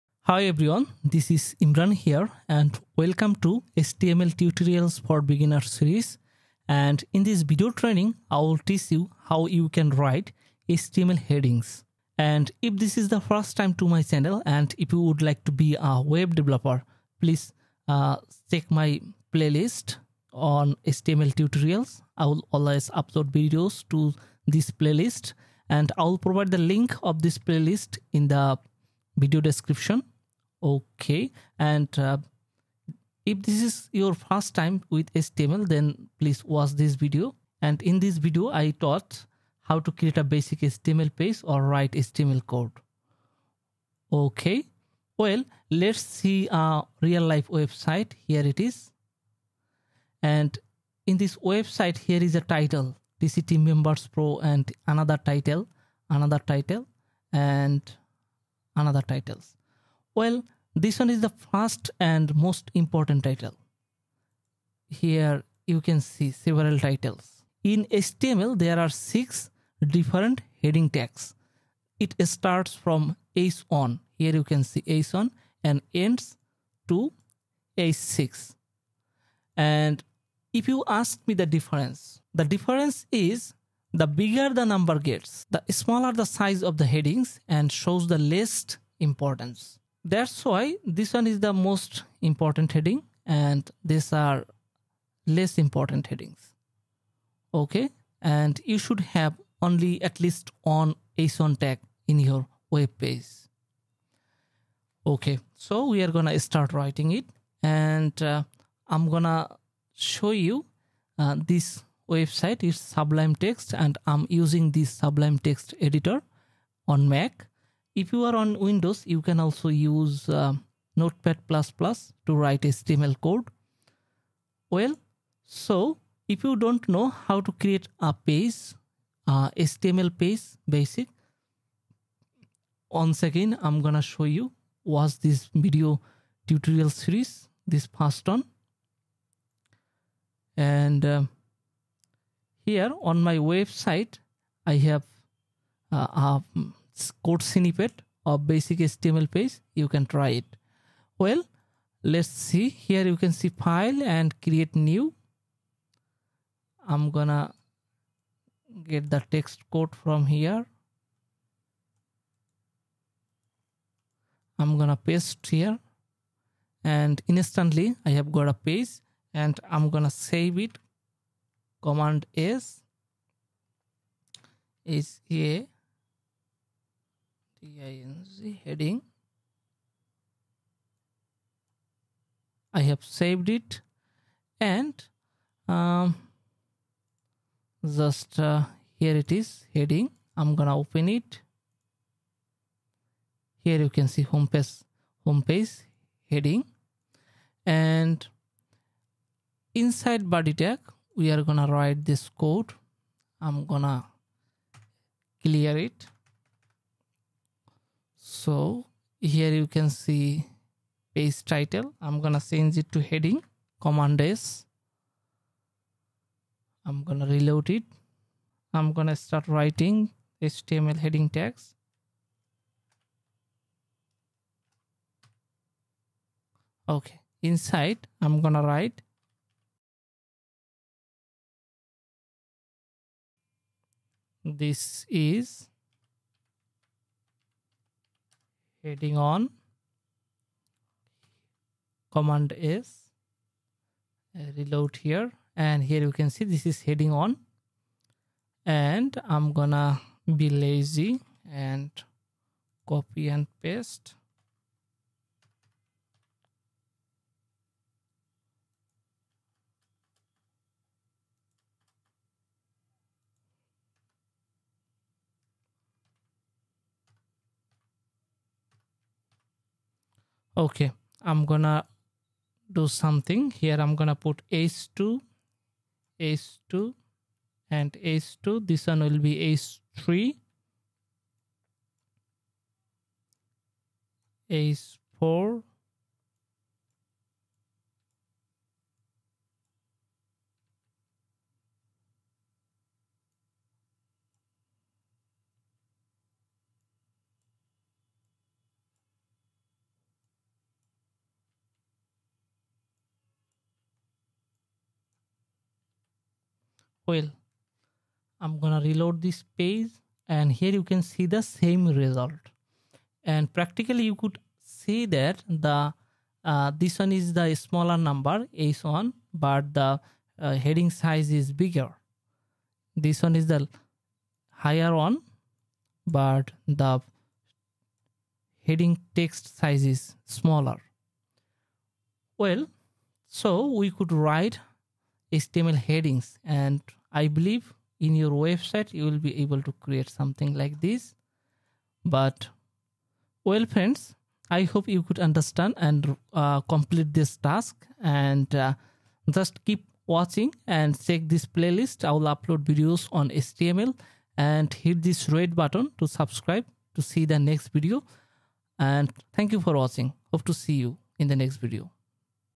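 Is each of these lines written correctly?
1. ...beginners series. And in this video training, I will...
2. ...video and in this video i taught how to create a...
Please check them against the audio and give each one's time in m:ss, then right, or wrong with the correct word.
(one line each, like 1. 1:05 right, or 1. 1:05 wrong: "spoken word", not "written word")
1. 0:05 right
2. 0:36 right.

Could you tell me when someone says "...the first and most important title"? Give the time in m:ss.
1:01.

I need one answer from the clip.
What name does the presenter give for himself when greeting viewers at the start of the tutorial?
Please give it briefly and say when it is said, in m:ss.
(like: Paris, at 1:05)
Imran, at 0:01.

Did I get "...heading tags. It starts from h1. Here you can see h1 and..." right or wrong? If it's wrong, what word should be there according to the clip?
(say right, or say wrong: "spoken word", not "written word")
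right.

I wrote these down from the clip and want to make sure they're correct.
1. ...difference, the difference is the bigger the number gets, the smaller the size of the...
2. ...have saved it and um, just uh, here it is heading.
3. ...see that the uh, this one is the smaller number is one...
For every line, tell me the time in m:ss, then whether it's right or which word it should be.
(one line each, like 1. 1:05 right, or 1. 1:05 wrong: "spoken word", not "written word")
1. 1:21 right
2. 3:02 right
3. 5:14 right.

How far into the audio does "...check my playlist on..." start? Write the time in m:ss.
0:18.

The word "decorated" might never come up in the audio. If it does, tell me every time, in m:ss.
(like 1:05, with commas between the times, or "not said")
not said.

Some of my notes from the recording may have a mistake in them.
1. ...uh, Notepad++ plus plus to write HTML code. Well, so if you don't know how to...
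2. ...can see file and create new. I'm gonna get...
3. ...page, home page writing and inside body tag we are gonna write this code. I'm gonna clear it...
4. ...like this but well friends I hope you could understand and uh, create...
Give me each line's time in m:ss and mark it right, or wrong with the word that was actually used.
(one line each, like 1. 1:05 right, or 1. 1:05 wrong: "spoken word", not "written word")
1. 2:00 right
2. 2:33 right
3. 3:14 wrong: "heading", not "writing"
4. 5:40 wrong: "complete", not "create".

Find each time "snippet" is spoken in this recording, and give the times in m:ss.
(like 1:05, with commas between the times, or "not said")
2:27.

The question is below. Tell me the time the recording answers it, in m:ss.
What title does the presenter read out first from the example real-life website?
0:53.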